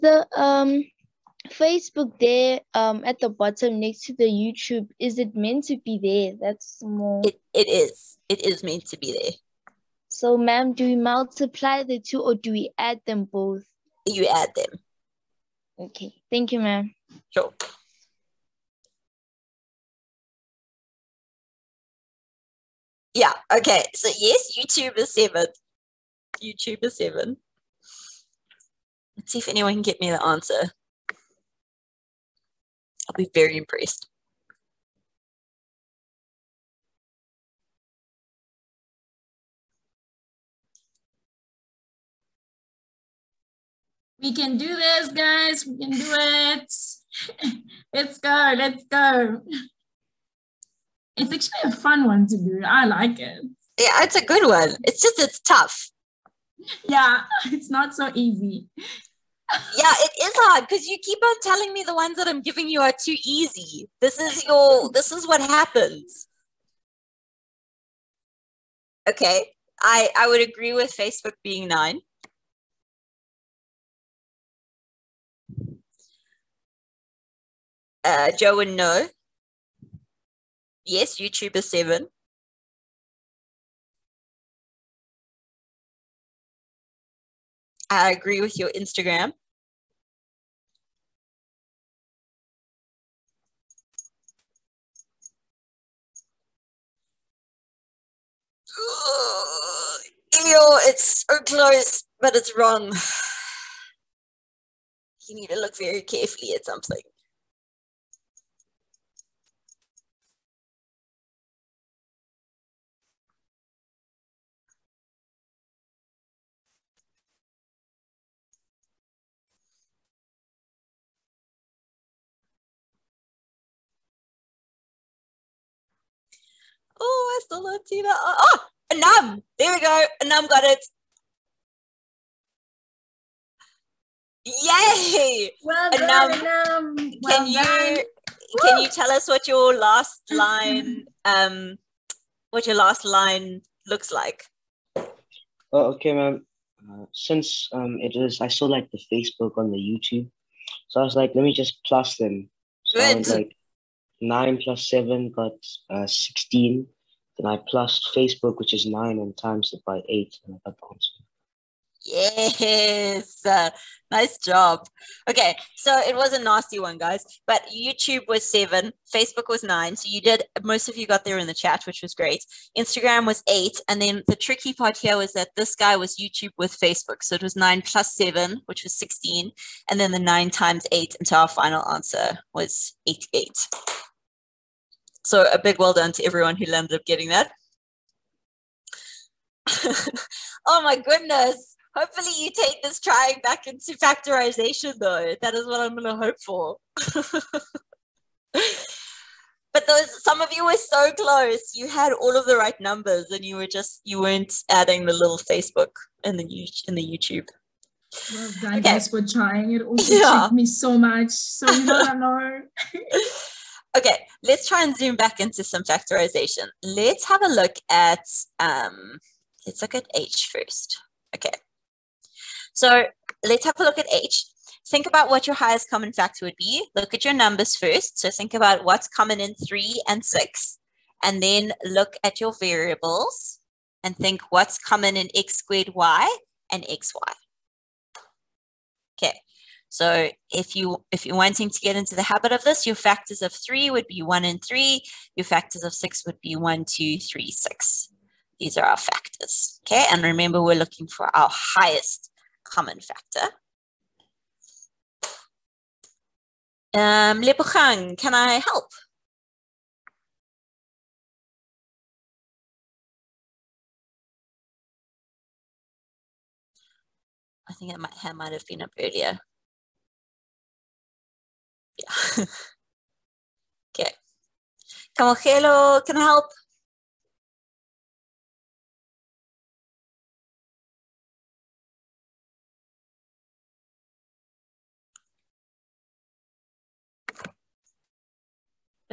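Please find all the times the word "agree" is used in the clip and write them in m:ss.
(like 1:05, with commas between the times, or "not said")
1:10, 1:28.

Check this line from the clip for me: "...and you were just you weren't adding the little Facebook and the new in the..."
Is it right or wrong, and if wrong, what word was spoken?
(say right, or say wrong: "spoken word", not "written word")
right.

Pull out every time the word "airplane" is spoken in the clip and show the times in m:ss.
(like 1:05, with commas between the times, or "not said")
not said.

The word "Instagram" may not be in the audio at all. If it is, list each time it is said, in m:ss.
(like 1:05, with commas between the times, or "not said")
1:28, 2:52.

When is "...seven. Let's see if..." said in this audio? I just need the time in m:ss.
0:26.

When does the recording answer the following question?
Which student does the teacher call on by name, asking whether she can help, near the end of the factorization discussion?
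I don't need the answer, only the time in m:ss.
4:17.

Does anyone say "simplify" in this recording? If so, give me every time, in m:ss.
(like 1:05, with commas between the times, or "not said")
not said.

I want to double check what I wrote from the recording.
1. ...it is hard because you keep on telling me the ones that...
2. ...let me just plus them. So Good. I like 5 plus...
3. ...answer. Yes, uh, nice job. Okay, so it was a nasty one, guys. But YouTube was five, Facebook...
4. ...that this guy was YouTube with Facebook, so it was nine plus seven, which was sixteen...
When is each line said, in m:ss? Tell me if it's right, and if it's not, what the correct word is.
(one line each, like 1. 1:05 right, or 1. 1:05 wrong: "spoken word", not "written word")
1. 0:59 right
2. 2:31 wrong: "9", not "5"
3. 2:40 wrong: "seven", not "five"
4. 2:55 right.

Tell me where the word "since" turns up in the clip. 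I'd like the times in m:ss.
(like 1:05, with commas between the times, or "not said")
2:27.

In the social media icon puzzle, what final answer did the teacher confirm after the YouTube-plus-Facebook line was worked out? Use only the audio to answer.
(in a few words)
88.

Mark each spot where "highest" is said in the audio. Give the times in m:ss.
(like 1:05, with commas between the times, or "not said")
3:45, 4:11.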